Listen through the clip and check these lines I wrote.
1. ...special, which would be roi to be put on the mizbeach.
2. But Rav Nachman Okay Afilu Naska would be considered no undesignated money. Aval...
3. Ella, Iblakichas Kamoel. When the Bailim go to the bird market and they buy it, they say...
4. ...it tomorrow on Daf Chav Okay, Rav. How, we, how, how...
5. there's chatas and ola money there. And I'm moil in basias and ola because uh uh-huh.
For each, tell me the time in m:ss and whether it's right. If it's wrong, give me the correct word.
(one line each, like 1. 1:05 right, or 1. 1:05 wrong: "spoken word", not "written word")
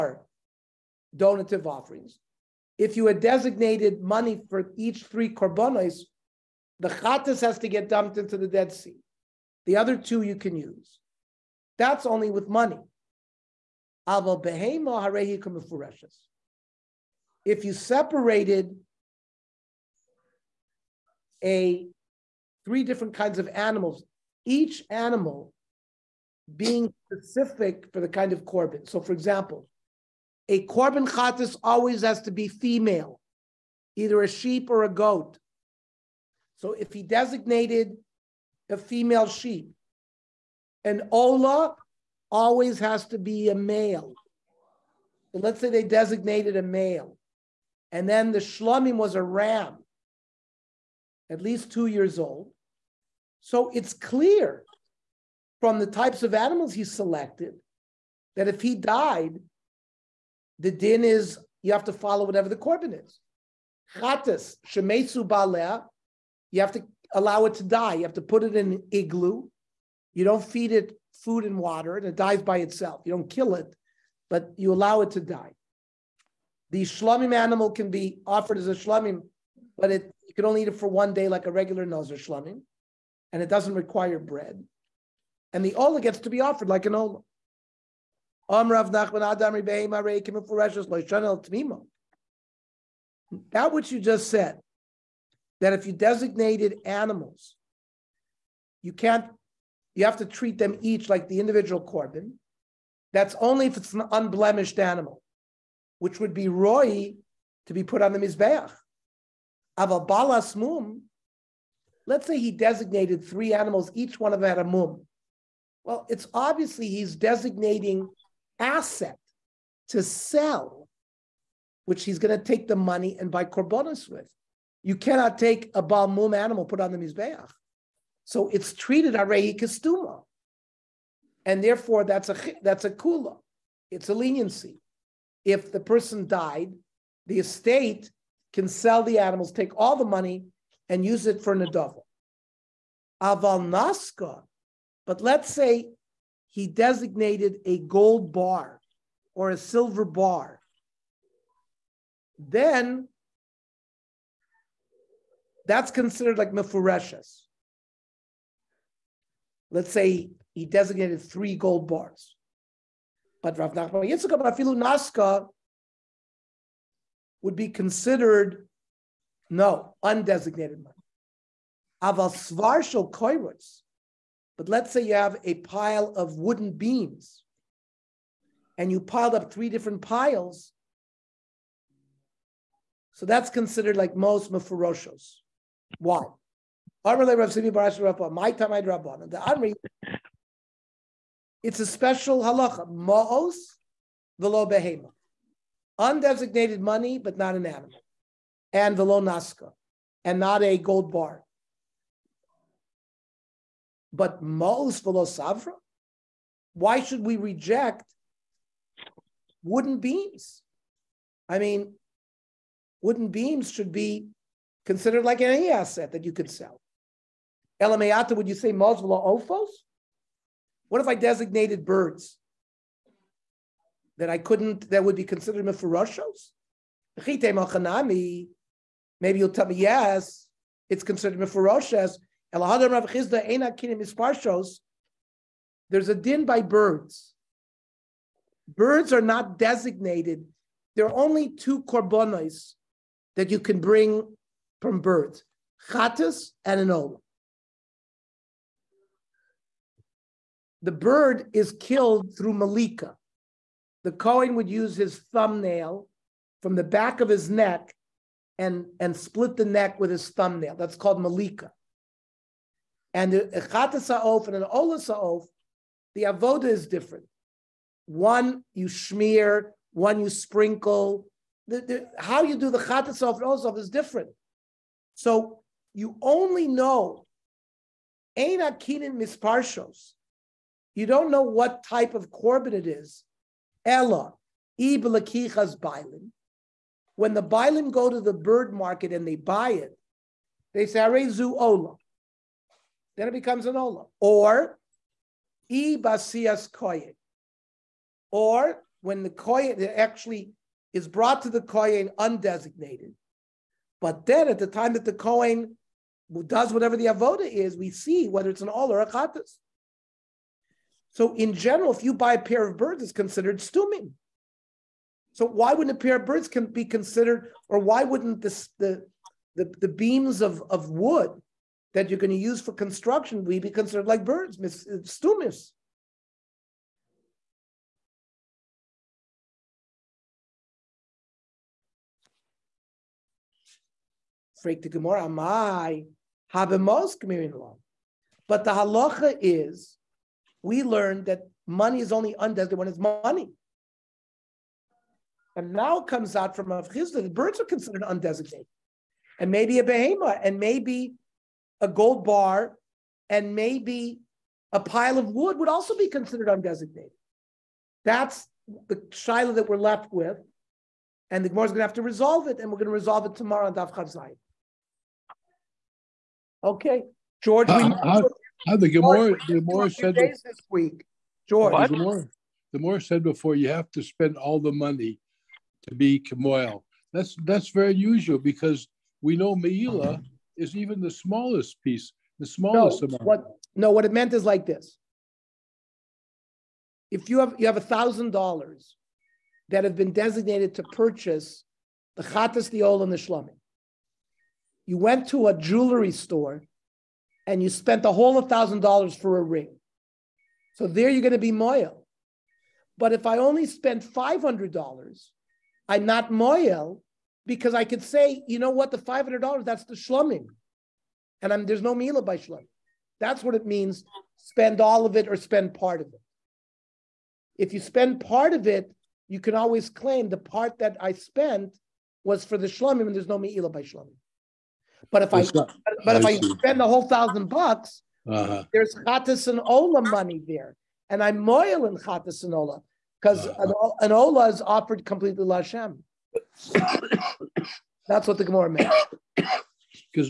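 1. 1:44 wrong: "animal", not "special"
2. 2:43 wrong: "Yitzchak", not "Okay"
3. 4:43 wrong: "Bailim", not "Kamoel"
4. 6:03 wrong: "George", not "Rav"
5. 7:08 wrong: "chatas", not "basias".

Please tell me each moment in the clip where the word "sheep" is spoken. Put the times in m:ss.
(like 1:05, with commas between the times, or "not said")
0:34, 0:39.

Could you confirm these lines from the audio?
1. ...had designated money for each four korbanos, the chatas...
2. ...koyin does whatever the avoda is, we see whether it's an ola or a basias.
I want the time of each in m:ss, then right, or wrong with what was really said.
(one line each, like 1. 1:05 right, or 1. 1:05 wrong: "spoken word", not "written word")
1. 0:03 wrong: "three", not "four"
2. 5:05 wrong: "chatas", not "basias".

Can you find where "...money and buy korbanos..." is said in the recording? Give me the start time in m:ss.
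2:02.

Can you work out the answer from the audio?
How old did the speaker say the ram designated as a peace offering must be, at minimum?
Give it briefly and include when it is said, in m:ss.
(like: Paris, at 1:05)
2 years, at 0:51.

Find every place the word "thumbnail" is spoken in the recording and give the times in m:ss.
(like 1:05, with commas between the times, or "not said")
4:15, 4:20.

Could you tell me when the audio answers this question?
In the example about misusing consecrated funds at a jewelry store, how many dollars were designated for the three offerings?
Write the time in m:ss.
6:27.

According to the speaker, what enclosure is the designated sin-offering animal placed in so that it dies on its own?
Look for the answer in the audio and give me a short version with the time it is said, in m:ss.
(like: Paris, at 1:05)
An igloo, at 1:08.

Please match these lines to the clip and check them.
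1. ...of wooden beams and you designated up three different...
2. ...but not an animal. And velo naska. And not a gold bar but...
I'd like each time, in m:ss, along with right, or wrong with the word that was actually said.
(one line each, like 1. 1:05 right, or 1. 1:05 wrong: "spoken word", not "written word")
1. 2:56 wrong: "piled", not "designated"
2. 3:17 right.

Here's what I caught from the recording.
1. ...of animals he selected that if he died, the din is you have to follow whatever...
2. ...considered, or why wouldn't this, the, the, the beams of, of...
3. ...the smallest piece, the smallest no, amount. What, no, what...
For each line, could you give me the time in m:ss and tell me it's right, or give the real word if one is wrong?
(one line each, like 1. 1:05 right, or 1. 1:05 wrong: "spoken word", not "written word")
1. 0:56 right
2. 5:16 right
3. 6:20 right.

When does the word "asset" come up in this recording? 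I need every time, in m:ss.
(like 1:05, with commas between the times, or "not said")
1:58, 3:35.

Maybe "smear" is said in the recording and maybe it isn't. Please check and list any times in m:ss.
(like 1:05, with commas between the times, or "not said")
4:28.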